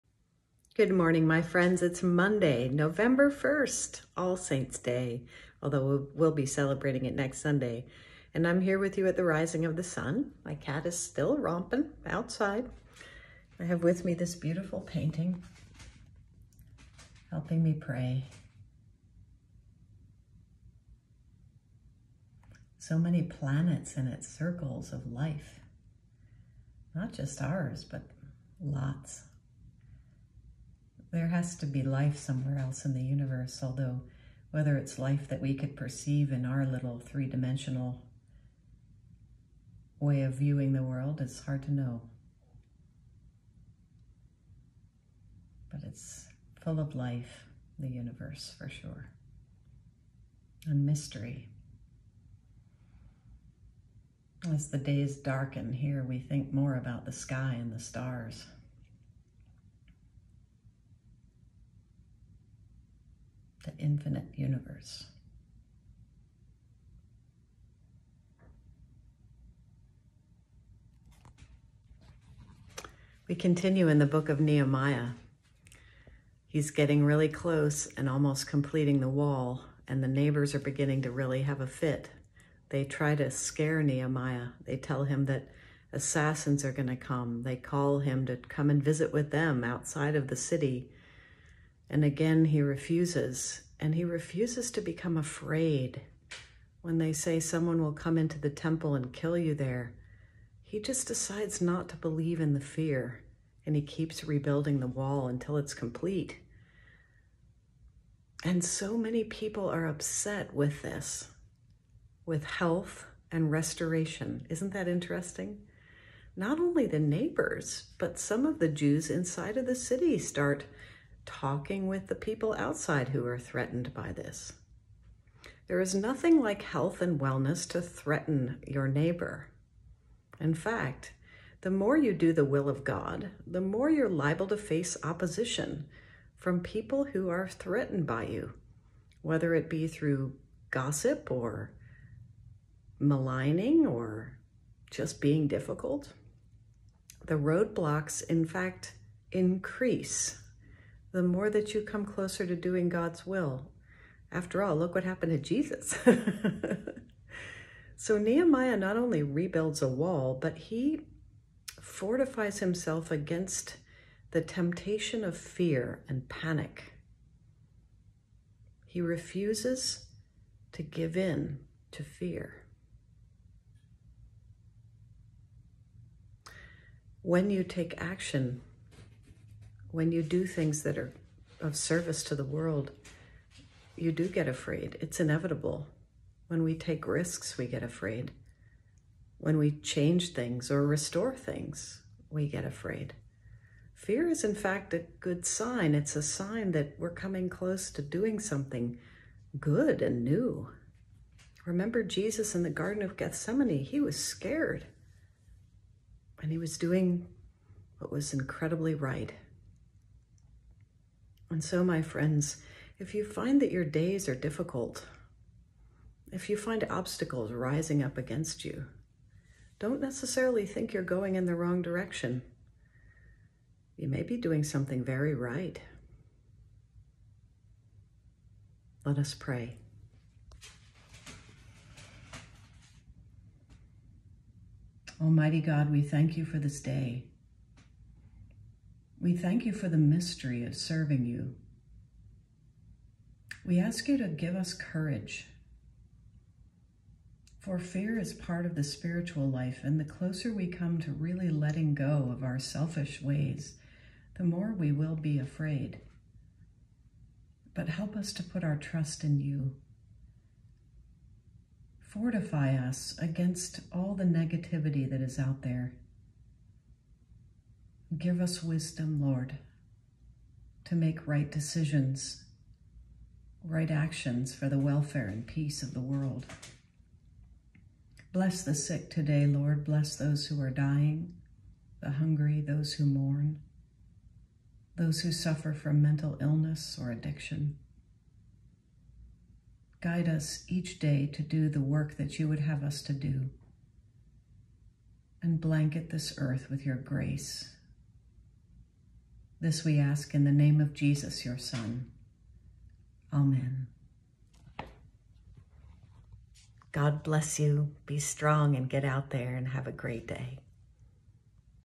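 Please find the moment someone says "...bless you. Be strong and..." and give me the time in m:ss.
5:07.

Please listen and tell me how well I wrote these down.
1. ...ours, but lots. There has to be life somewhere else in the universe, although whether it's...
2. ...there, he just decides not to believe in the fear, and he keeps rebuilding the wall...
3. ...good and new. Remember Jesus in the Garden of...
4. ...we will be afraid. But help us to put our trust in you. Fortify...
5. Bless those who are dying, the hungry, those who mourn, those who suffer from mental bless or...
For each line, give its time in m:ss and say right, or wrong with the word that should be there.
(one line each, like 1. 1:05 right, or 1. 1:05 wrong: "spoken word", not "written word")
1. 0:27 right
2. 1:39 right
3. 3:19 right
4. 4:14 right
5. 4:39 wrong: "illness", not "bless".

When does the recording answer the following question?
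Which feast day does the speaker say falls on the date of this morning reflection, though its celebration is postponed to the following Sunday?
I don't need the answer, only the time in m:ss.
0:04.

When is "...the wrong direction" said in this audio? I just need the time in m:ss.
3:41.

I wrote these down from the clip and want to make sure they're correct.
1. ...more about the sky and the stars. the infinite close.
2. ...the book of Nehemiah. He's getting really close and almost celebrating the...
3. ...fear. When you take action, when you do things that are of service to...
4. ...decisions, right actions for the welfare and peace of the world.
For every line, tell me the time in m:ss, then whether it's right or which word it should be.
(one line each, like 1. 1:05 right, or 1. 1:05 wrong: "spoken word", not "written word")
1. 0:56 wrong: "universe", not "close"
2. 1:13 wrong: "completing", not "celebrating"
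3. 2:52 right
4. 4:31 right.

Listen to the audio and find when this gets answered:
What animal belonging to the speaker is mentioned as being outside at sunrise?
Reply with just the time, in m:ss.
0:10.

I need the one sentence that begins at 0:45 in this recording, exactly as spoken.
But it's full of life, the universe, for sure, and mystery.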